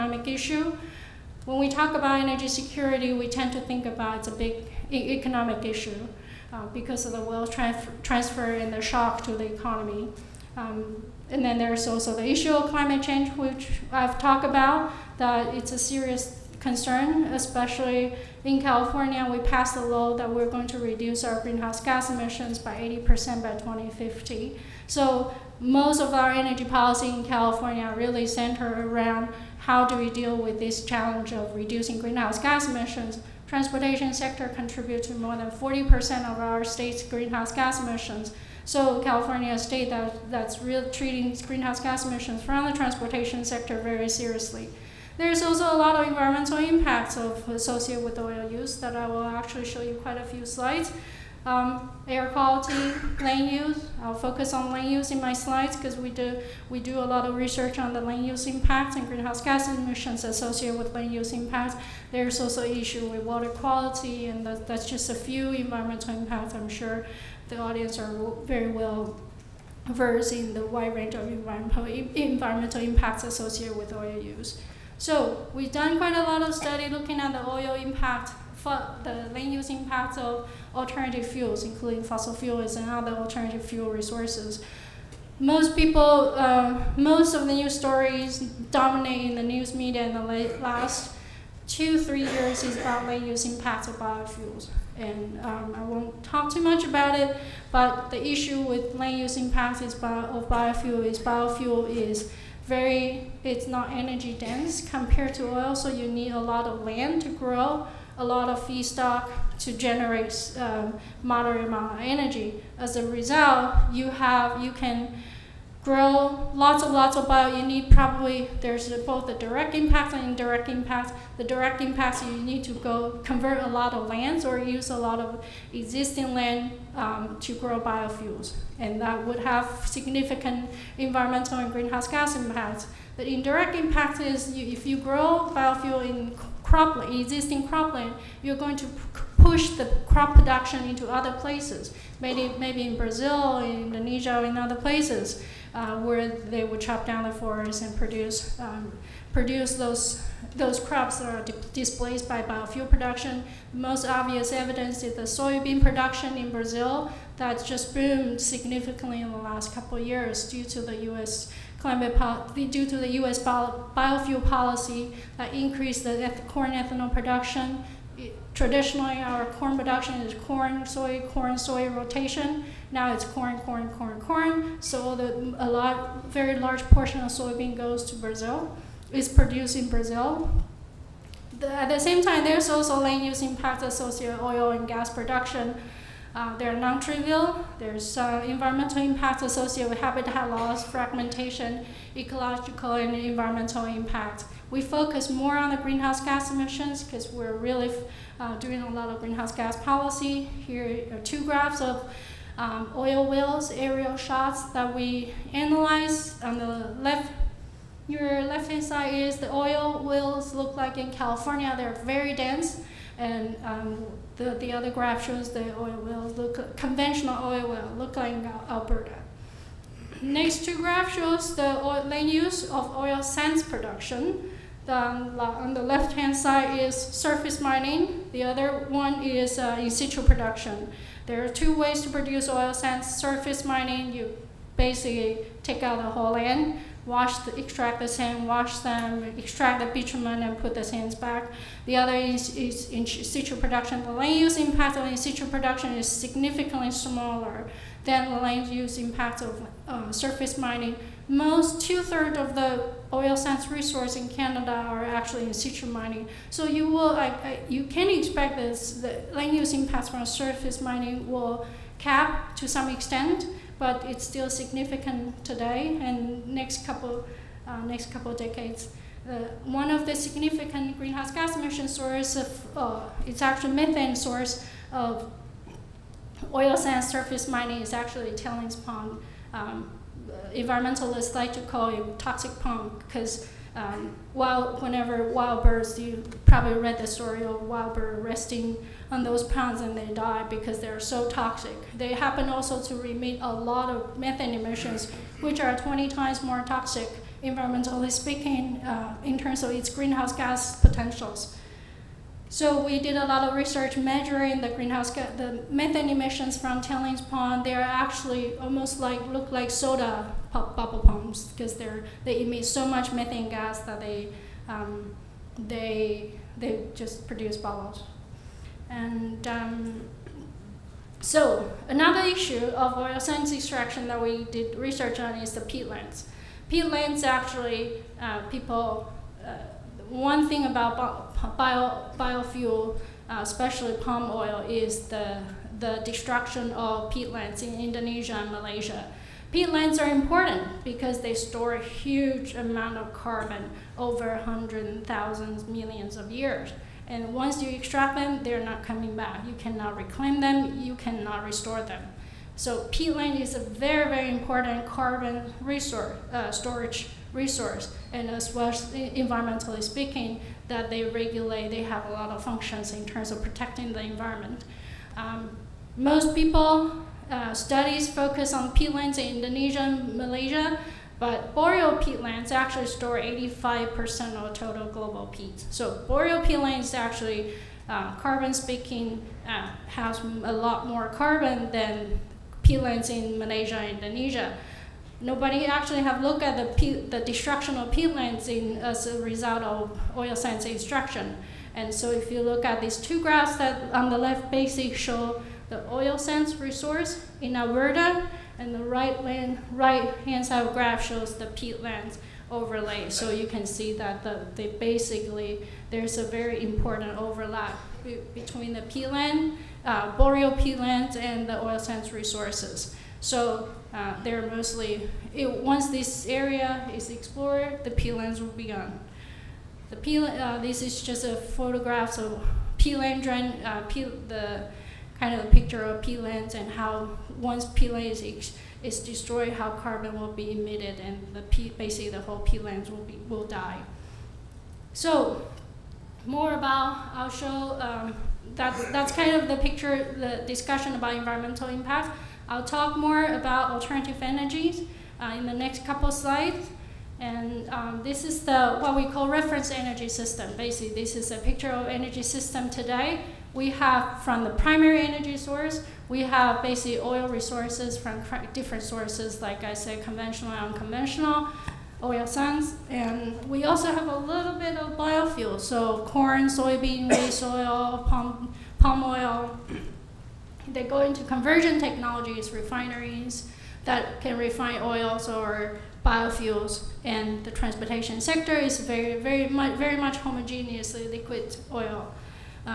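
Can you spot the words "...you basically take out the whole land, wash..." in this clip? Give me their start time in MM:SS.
03:54.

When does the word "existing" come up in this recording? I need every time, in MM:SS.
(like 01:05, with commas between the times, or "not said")
02:05, 02:17.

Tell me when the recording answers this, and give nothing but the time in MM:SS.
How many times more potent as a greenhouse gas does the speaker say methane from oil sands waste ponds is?
04:55.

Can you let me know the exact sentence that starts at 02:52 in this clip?
Now it's corn, corn, corn, corn.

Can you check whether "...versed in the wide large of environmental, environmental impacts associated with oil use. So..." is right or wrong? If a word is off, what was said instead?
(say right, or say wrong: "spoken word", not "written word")
wrong: "range", not "large".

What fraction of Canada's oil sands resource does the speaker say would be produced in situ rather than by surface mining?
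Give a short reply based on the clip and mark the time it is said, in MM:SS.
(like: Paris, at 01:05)
two-thirds, at 04:11.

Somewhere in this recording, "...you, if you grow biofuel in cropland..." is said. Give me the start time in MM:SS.
02:14.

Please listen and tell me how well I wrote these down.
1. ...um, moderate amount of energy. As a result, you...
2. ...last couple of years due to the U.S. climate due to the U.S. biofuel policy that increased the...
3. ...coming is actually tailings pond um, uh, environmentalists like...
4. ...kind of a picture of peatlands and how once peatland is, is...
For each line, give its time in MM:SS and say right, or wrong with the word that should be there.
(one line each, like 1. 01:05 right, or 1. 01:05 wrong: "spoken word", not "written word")
1. 01:50 right
2. 02:39 right
3. 04:37 wrong: "mining", not "coming"
4. 07:05 right.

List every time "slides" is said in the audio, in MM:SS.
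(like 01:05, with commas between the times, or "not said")
00:50, 00:55, 07:26.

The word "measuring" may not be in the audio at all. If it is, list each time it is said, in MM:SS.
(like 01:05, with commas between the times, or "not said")
05:03.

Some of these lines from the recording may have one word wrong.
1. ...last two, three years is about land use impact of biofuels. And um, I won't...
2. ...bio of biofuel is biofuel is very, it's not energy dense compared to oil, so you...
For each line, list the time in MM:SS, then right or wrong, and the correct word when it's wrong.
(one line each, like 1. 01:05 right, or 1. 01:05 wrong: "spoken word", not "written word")
1. 01:30 right
2. 01:39 right.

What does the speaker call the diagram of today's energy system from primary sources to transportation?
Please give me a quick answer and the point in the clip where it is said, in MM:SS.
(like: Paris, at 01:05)
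reference energy system, at 07:29.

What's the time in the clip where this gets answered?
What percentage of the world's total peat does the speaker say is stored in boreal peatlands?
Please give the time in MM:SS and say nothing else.
06:13.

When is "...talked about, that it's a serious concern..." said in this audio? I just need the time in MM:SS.
00:14.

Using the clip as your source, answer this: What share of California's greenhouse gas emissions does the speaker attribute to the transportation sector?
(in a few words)
more than 40%.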